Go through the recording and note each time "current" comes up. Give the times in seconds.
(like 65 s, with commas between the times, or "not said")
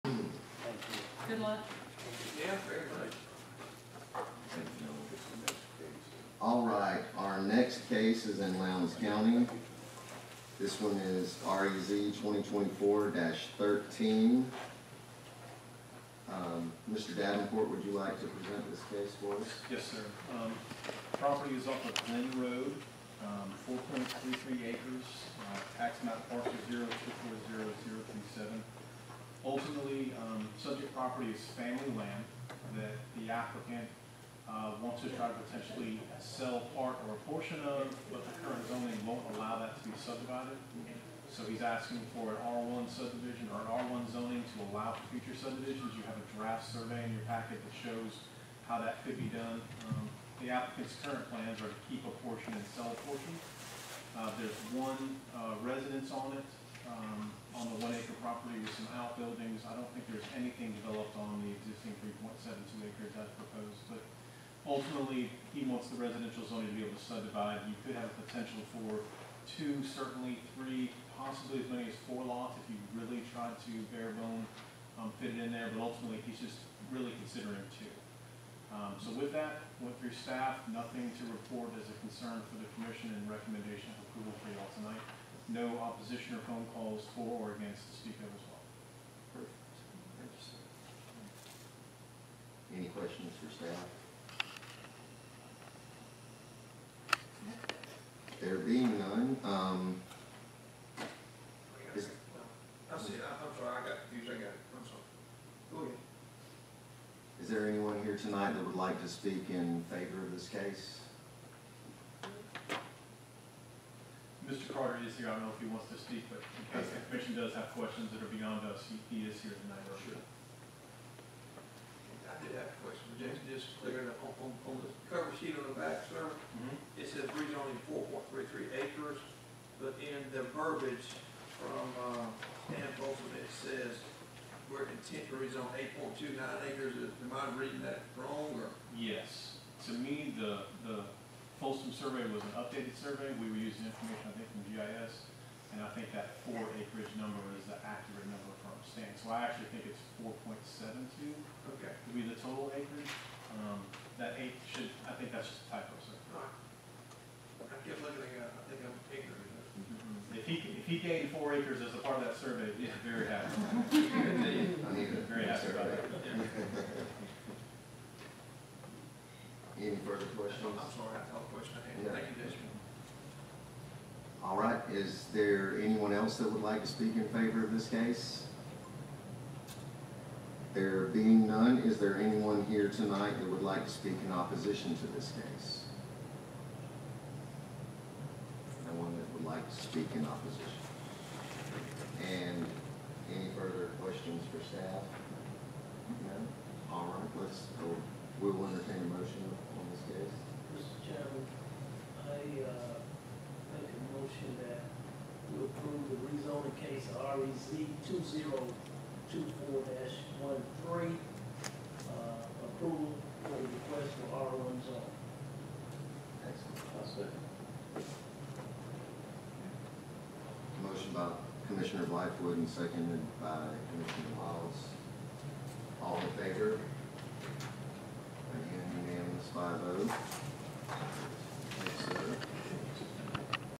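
38 s, 51 s.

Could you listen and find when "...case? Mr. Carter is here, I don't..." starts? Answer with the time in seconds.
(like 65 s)
110 s.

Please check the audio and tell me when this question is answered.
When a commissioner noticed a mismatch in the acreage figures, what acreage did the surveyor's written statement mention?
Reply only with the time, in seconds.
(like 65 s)
135 s.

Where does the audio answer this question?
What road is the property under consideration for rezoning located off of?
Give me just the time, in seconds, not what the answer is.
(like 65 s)
22 s.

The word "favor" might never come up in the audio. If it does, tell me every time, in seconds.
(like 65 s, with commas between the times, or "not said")
109 s, 177 s, 226 s.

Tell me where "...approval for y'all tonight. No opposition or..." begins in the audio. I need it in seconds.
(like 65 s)
84 s.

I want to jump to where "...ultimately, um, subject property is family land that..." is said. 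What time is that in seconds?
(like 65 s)
29 s.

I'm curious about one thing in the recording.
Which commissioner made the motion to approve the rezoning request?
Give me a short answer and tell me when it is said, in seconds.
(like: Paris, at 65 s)
Commissioner Blackwood, at 221 s.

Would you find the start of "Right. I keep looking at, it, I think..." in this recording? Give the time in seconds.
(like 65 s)
156 s.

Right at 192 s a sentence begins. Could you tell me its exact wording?
And any further questions for staff?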